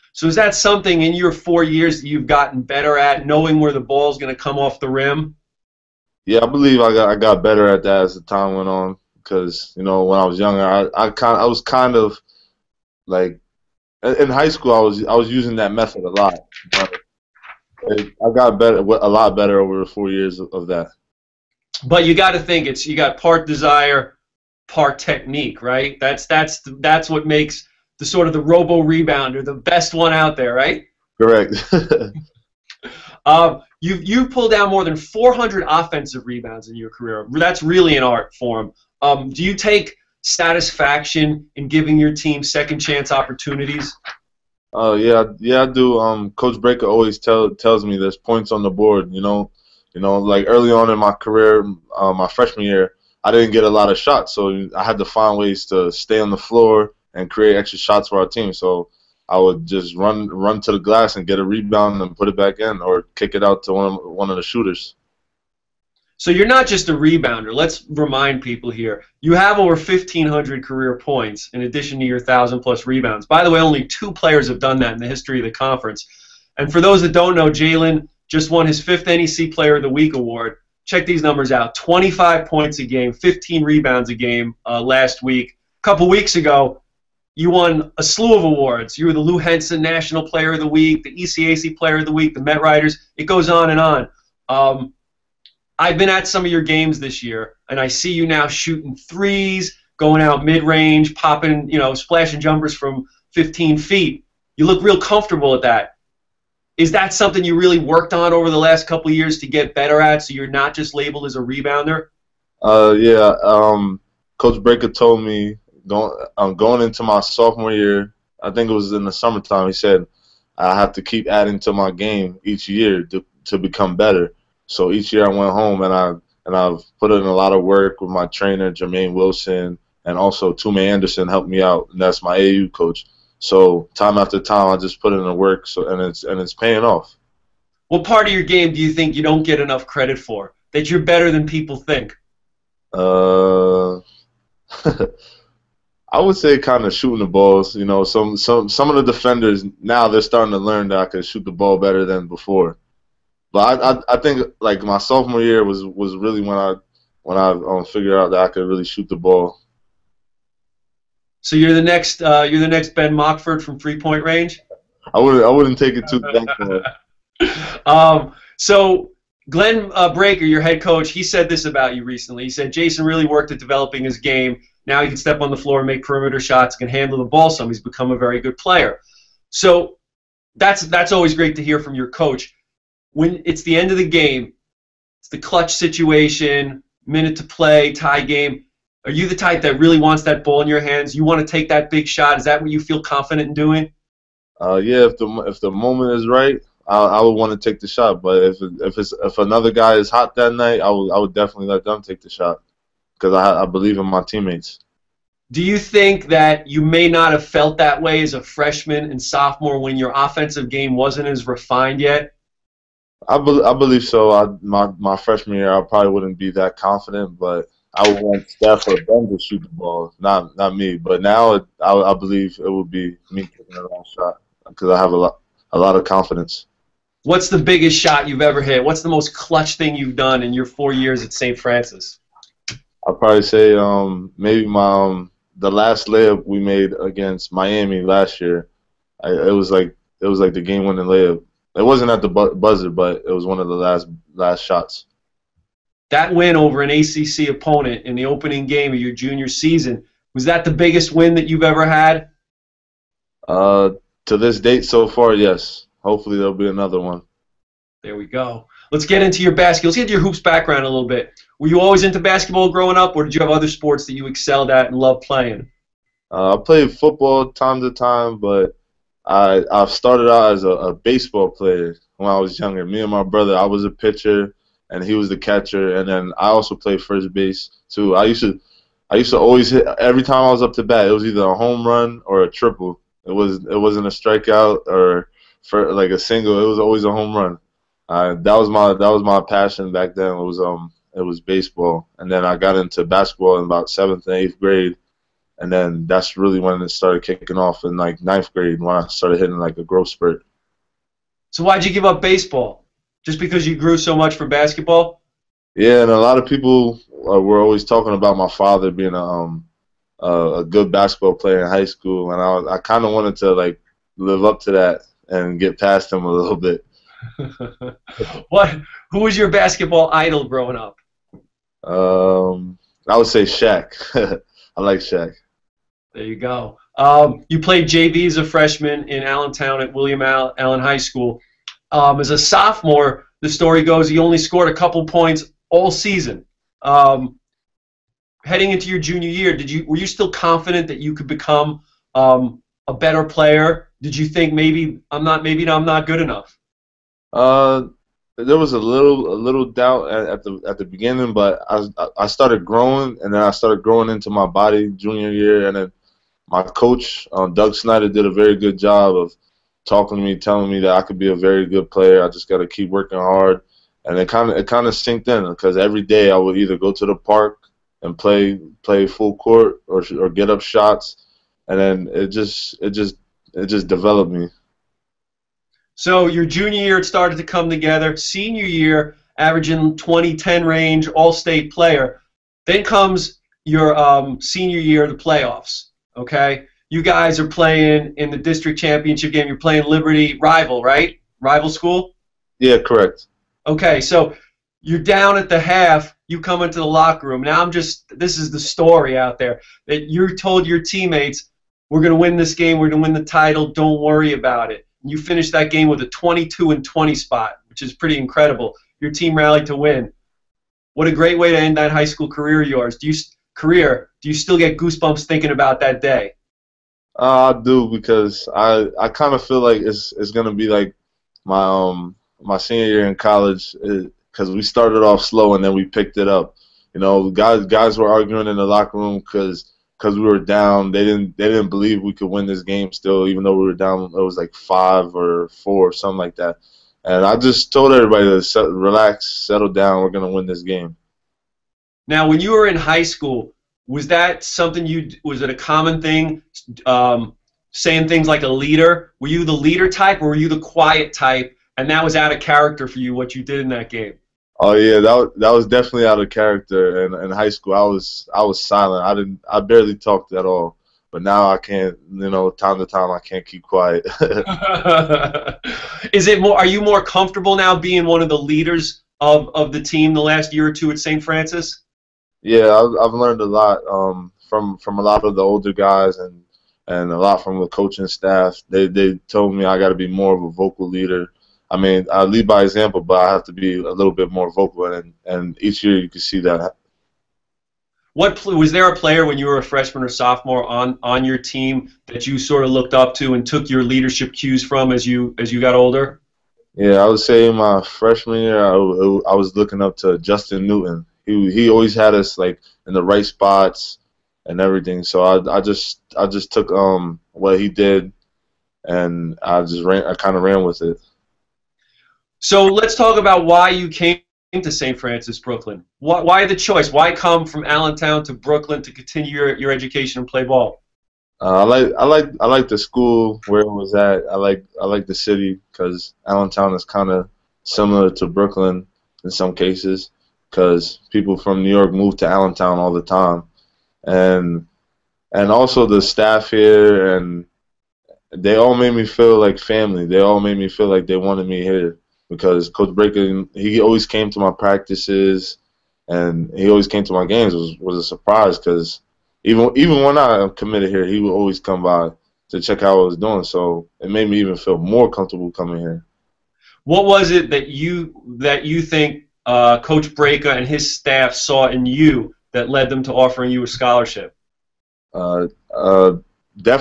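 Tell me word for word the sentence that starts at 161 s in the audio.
So you're the next uh, you're the next Ben Mockford from three point range.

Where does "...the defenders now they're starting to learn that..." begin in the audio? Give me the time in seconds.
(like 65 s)
148 s.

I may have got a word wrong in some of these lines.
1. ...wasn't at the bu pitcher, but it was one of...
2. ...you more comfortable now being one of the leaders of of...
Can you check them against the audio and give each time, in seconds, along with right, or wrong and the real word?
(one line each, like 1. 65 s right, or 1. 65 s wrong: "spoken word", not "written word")
1. 241 s wrong: "buzzer", not "pitcher"
2. 466 s right.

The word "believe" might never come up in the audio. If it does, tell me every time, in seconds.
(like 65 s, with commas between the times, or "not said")
6 s, 203 s, 213 s, 222 s, 431 s.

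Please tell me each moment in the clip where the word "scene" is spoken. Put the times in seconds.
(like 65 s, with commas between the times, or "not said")
not said.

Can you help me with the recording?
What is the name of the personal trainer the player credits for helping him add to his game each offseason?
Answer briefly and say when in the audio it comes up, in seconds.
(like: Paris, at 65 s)
Jermaine Wilson, at 128 s.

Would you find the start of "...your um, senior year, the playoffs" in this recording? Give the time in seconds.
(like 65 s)
383 s.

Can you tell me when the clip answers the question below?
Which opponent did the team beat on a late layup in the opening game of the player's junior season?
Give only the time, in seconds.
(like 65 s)
237 s.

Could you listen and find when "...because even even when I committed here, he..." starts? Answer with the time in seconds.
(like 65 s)
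548 s.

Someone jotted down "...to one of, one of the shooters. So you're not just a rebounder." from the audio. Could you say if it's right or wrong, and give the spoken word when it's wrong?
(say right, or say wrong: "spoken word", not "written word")
right.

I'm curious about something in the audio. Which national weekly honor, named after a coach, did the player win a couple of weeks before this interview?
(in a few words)
Lou Henson National Player of the Week.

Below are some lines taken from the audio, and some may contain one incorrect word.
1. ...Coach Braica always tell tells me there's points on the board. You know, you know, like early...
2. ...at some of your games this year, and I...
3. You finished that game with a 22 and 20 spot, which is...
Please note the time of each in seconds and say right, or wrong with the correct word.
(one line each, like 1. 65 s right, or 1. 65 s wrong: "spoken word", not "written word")
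1. 46 s right
2. 96 s right
3. 405 s right.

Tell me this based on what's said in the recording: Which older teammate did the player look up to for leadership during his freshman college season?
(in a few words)
Justin Newton.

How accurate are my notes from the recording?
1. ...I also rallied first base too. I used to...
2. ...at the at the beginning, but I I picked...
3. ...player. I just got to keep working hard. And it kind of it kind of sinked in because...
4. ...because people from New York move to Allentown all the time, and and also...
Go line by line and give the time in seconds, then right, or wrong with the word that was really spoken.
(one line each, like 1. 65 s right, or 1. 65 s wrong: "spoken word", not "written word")
1. 276 s wrong: "played", not "rallied"
2. 350 s wrong: "started", not "picked"
3. 361 s right
4. 530 s right.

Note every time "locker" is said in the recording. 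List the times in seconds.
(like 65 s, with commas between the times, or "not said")
396 s, 428 s.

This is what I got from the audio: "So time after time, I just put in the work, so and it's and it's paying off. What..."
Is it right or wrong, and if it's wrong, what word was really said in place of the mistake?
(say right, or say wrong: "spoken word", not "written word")
right.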